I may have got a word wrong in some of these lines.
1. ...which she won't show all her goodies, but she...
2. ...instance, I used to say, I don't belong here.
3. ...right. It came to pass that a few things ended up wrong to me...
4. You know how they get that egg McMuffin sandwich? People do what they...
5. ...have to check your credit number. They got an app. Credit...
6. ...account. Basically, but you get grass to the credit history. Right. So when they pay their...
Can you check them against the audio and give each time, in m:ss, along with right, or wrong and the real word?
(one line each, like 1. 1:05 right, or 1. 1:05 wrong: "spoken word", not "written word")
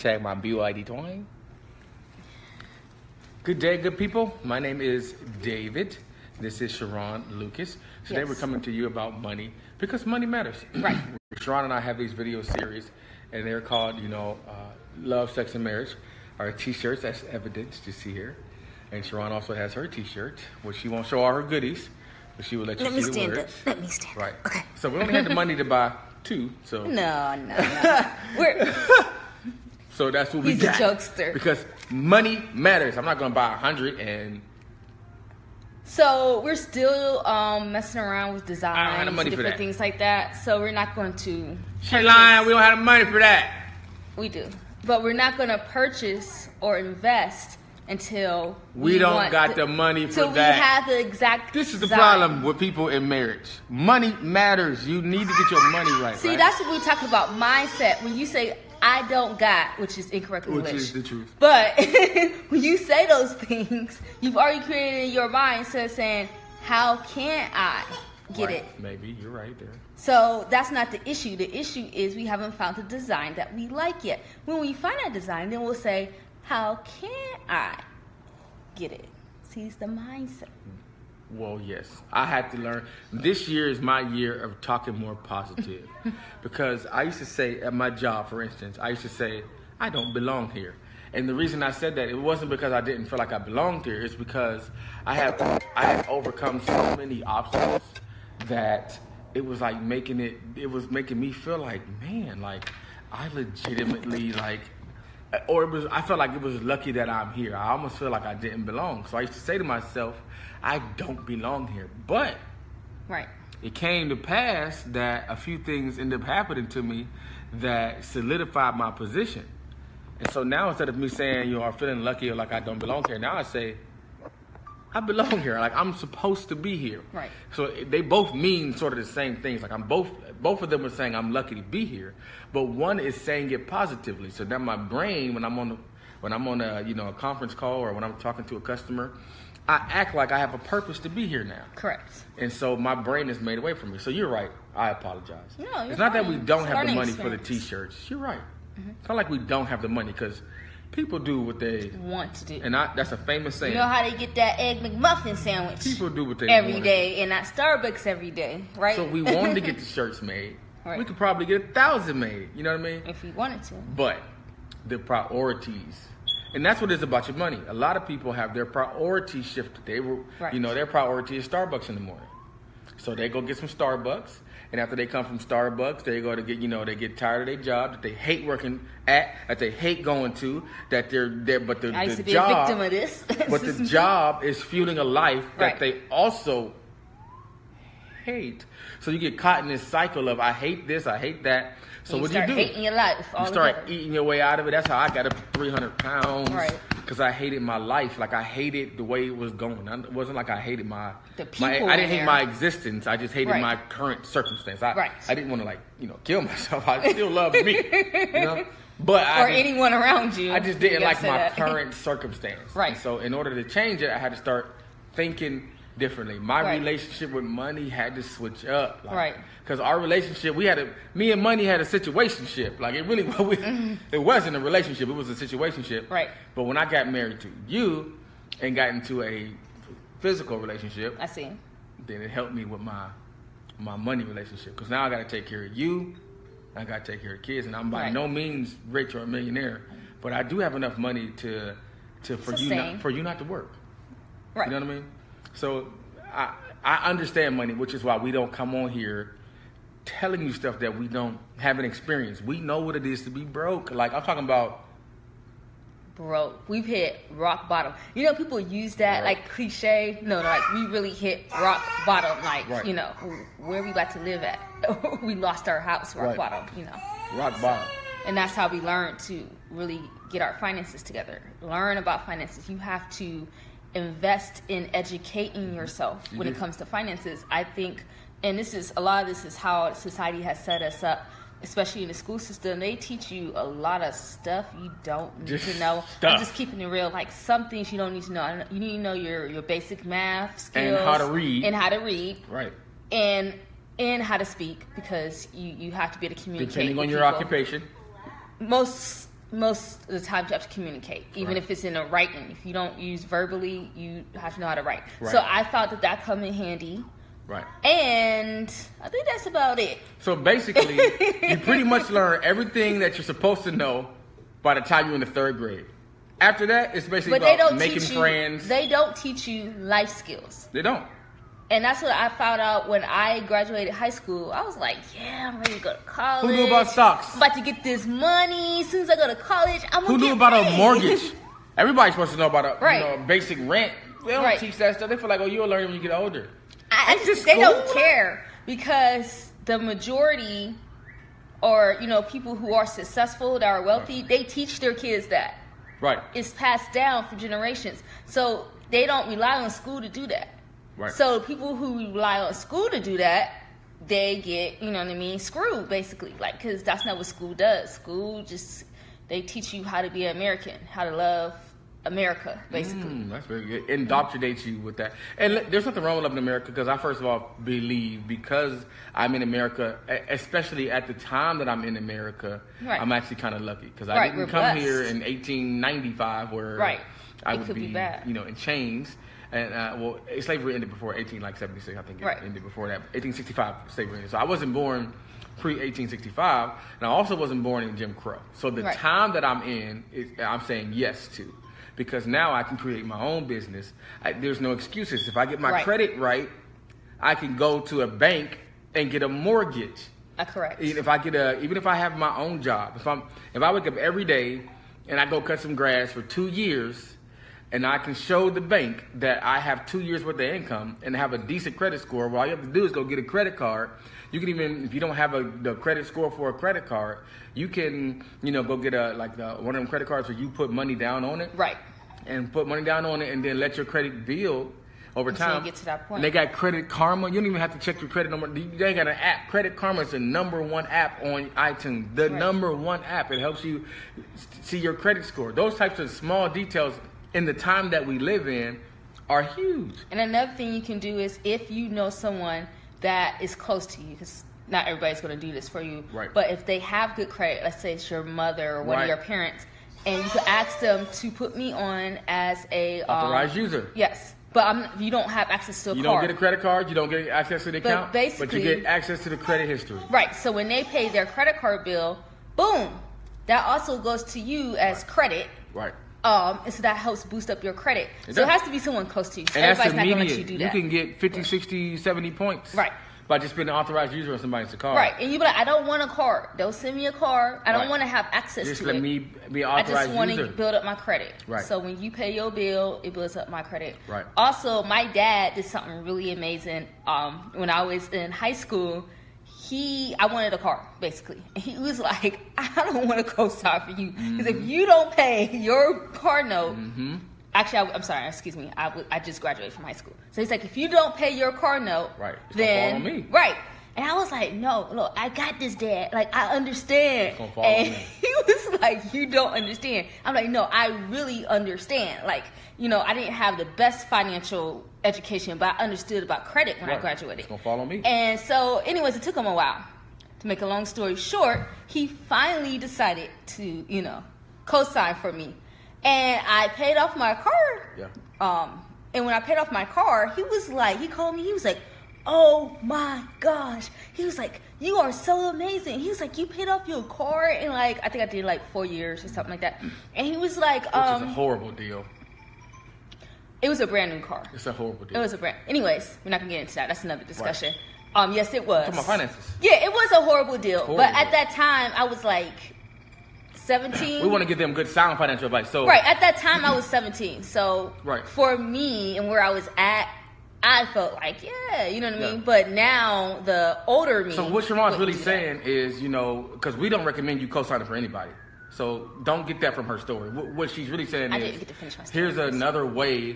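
1. 0:20 right
2. 1:28 right
3. 1:53 wrong: "happening", not "wrong"
4. 2:33 right
5. 7:07 right
6. 7:37 wrong: "access", not "grass".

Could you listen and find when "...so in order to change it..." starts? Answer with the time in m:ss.
3:32.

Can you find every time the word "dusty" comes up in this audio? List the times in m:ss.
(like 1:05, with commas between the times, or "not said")
not said.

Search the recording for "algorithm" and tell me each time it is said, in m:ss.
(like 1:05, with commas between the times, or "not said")
not said.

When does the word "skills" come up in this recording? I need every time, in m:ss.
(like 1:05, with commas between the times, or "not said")
4:50, 5:20.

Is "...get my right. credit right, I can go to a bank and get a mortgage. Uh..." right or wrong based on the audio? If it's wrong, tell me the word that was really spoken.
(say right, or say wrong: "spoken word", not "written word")
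right.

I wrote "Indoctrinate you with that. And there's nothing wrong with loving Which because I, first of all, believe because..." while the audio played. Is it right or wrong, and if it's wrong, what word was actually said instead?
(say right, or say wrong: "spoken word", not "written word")
wrong: "America", not "Which".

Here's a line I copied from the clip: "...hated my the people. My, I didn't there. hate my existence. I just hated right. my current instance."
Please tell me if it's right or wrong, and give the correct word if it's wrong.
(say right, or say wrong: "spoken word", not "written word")
wrong: "circumstance", not "instance".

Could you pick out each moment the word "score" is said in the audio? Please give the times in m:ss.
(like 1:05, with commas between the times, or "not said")
6:51, 6:56, 7:15.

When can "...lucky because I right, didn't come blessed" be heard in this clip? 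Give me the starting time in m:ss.
6:13.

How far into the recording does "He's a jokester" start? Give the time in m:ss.
0:30.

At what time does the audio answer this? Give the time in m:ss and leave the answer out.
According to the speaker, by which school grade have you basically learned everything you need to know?
5:15.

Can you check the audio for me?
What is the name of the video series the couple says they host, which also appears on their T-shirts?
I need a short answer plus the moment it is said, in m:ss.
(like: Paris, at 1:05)
Love, Sex, and Marriage, at 0:14.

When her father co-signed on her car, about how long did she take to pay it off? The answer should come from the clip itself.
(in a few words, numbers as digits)
4 years.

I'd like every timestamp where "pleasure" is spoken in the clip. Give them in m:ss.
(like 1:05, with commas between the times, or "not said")
not said.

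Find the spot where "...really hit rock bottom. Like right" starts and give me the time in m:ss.
4:20.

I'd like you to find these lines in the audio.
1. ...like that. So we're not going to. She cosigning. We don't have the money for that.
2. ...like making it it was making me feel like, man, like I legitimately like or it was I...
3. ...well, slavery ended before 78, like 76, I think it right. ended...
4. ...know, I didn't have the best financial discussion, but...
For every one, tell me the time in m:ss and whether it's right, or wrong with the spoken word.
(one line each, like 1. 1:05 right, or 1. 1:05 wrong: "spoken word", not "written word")
1. 0:39 wrong: "lying", not "cosigning"
2. 1:39 right
3. 6:19 wrong: "18", not "78"
4. 8:32 wrong: "education", not "discussion".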